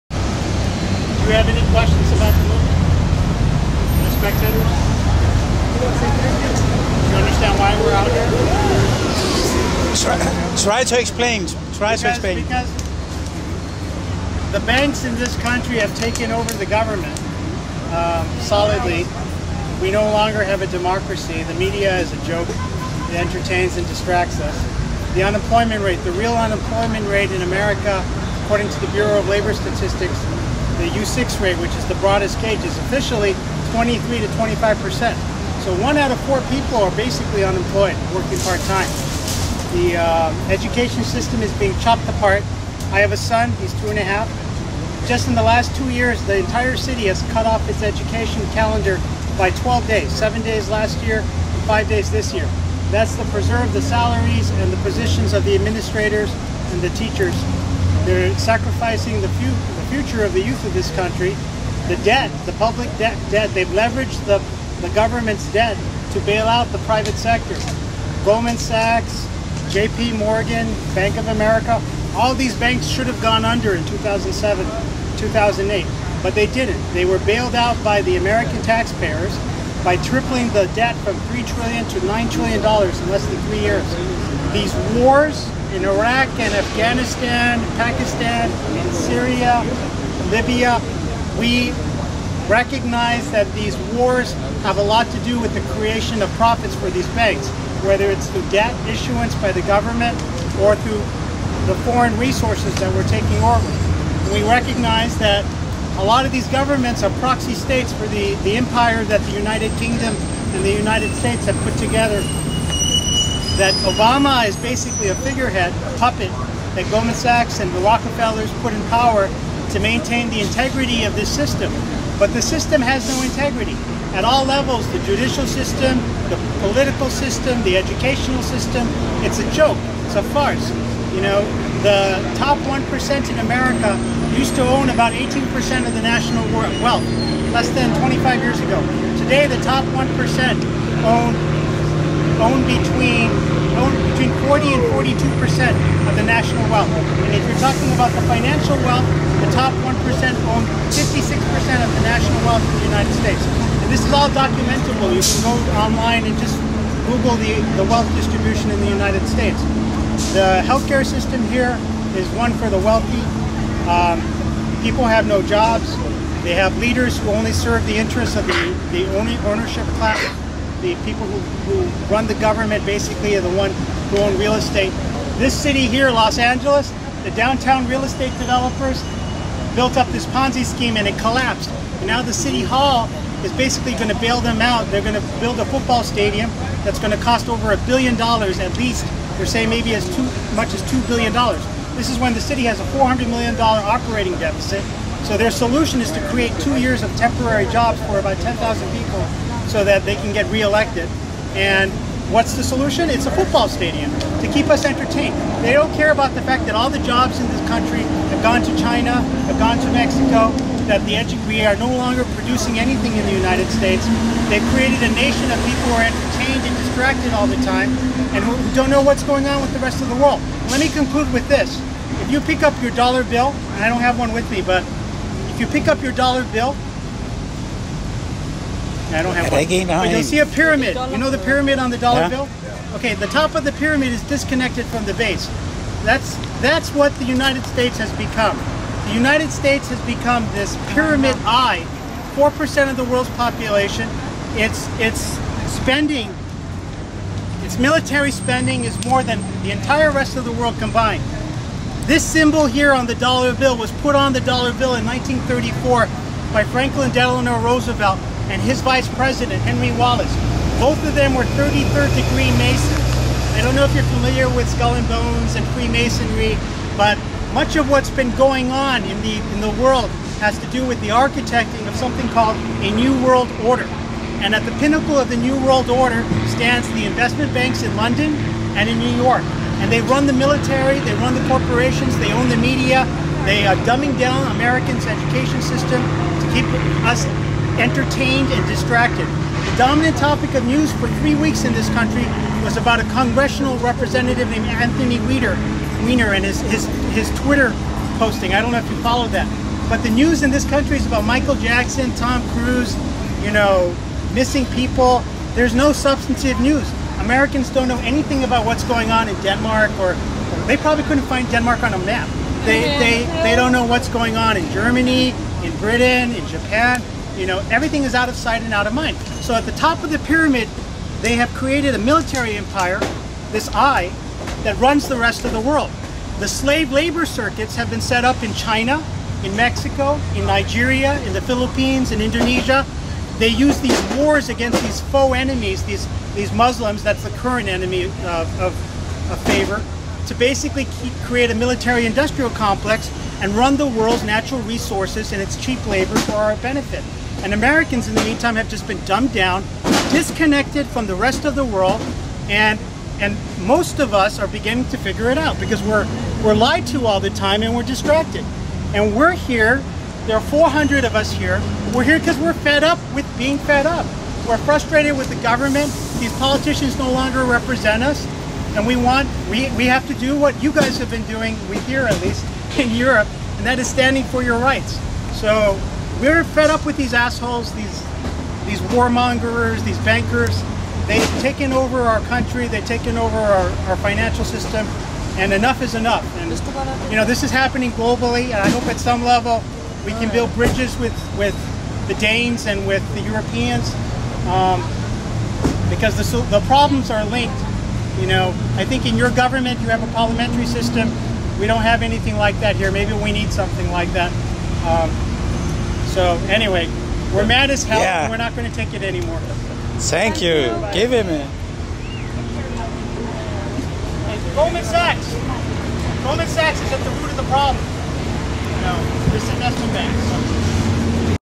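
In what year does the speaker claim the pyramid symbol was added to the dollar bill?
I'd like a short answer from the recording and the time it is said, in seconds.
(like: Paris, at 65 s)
1934, at 255 s.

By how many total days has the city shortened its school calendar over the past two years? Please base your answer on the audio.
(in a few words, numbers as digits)
12 days.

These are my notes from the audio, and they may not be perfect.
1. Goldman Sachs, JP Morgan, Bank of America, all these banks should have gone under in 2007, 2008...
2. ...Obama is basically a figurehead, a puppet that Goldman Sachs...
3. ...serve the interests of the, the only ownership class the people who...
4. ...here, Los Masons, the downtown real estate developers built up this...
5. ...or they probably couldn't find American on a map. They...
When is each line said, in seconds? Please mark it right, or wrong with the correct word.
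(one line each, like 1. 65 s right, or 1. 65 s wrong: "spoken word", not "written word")
1. 68 s right
2. 113 s right
3. 167 s right
4. 175 s wrong: "Angeles", not "Masons"
5. 310 s wrong: "Denmark", not "American".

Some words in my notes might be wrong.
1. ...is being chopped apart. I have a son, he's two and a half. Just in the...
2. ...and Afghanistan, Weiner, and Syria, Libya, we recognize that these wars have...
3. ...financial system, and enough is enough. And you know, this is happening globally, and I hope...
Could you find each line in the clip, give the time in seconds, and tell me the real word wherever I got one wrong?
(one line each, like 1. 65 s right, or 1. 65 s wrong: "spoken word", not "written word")
1. 41 s right
2. 86 s wrong: "Pakistan", not "Weiner"
3. 383 s right.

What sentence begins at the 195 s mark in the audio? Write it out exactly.
So their solution is to create two years of temporary jobs for about 10,000 people so that they can get reelected.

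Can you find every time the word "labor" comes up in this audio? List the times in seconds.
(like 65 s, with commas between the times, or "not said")
29 s, 326 s, 345 s.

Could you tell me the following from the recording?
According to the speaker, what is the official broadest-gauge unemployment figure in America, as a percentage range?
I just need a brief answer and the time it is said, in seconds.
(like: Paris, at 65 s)
23 to 25%, at 33 s.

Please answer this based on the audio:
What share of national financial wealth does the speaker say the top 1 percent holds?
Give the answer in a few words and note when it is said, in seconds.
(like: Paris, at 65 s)
56 percent, at 150 s.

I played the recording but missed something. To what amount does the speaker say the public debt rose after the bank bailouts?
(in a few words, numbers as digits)
$9 trillion.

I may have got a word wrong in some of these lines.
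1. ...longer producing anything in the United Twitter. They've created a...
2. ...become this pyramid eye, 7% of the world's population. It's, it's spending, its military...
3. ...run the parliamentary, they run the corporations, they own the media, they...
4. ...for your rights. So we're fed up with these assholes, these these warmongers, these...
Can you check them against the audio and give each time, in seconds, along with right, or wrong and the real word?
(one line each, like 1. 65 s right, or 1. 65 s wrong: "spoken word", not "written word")
1. 211 s wrong: "States", not "Twitter"
2. 240 s wrong: "4", not "7"
3. 280 s wrong: "military", not "parliamentary"
4. 374 s right.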